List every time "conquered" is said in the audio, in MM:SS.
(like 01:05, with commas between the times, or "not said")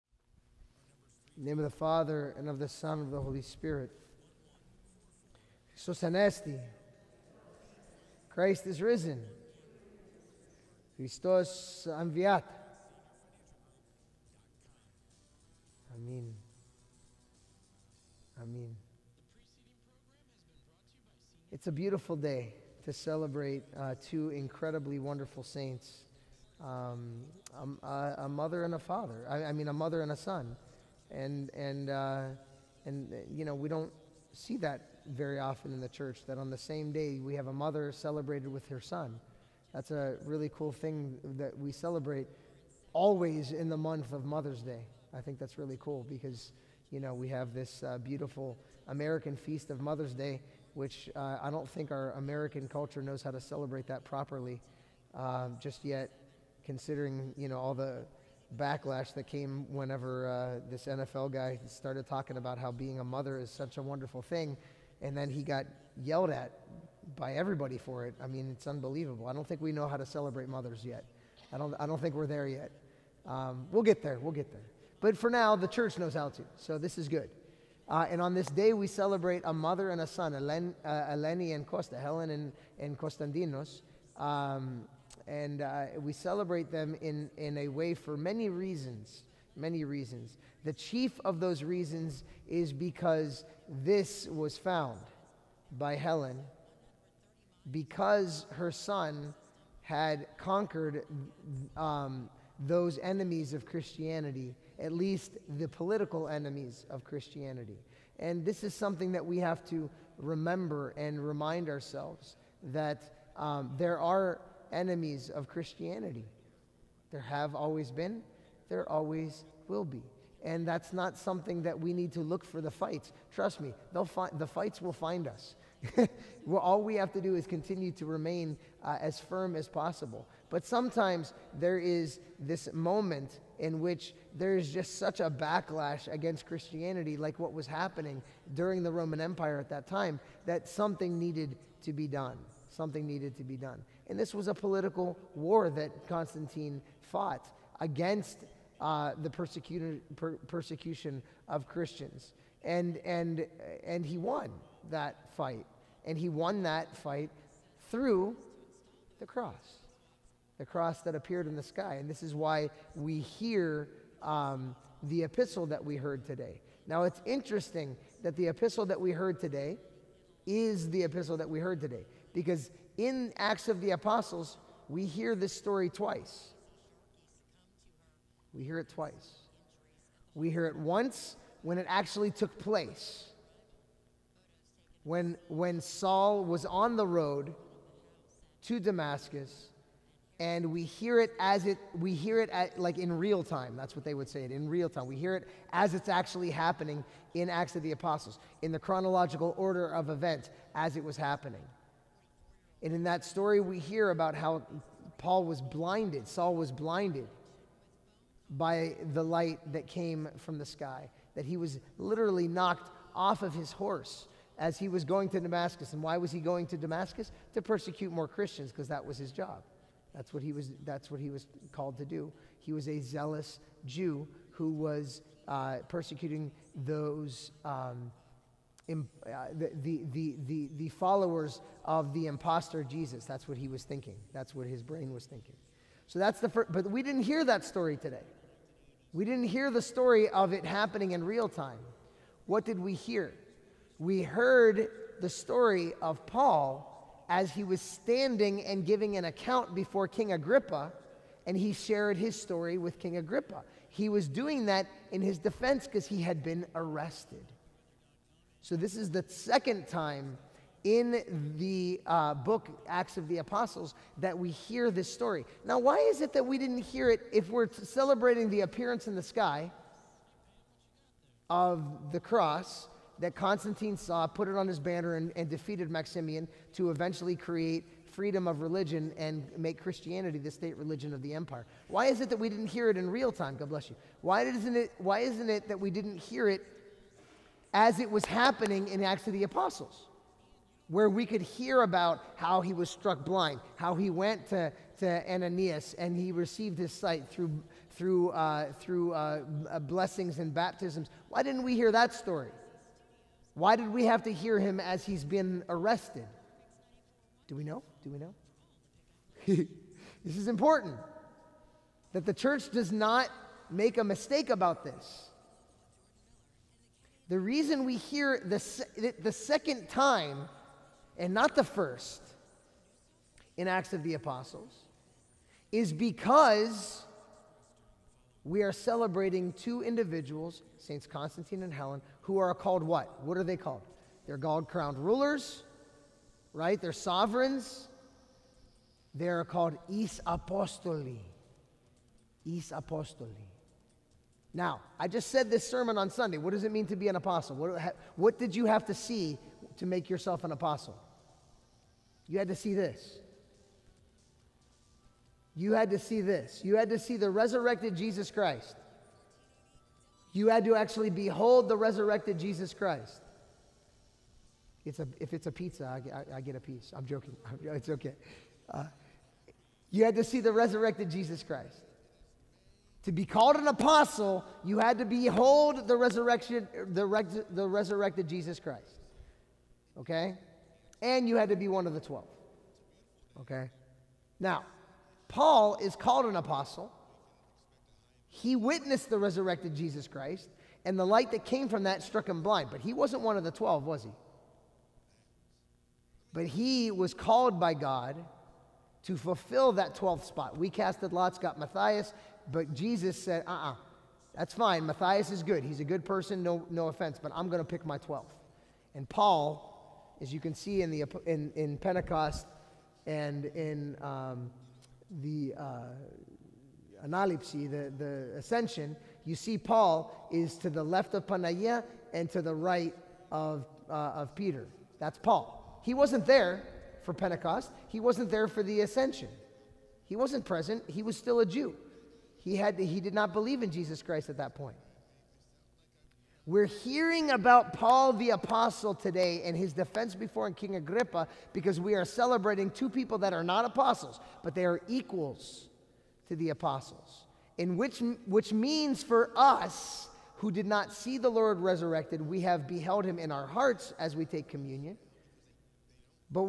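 01:40.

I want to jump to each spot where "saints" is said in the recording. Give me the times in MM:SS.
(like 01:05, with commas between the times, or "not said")
00:25, 05:30.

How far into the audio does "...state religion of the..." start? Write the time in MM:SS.
04:40.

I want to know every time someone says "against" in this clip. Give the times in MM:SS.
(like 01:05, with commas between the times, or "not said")
02:16, 02:27.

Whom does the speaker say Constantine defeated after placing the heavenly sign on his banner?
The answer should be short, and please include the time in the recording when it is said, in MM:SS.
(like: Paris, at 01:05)
Maximian, at 04:35.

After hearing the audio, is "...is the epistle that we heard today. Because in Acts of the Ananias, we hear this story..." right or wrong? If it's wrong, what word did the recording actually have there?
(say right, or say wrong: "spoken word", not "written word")
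wrong: "Apostles", not "Ananias".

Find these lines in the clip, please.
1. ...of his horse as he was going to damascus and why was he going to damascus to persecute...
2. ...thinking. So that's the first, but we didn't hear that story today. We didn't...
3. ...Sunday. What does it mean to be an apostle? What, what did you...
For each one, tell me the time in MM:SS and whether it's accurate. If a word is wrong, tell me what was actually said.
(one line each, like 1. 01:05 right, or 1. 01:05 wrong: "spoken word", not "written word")
1. 03:33 right
2. 03:55 right
3. 05:46 right.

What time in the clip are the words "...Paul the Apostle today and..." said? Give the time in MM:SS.
07:17.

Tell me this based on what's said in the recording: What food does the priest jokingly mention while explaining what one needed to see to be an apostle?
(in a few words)
pizza.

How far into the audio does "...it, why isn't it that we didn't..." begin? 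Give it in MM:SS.
04:44.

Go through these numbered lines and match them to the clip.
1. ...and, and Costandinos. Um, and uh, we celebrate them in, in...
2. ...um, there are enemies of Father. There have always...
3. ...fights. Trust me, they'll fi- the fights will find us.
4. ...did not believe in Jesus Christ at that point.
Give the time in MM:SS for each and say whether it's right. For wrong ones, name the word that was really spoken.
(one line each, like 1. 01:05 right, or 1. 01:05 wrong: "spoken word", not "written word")
1. 01:22 right
2. 01:53 wrong: "Christianity", not "Father"
3. 02:02 right
4. 07:13 right.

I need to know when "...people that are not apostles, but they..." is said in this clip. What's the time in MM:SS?
07:22.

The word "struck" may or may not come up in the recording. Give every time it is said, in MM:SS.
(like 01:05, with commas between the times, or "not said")
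04:52, 06:32.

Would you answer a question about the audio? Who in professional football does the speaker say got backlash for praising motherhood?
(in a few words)
NFL guy.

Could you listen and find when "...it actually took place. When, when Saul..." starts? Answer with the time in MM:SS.
03:01.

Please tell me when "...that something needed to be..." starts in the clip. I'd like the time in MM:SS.
02:20.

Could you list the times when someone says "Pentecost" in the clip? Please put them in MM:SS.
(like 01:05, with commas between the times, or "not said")
06:51, 07:07.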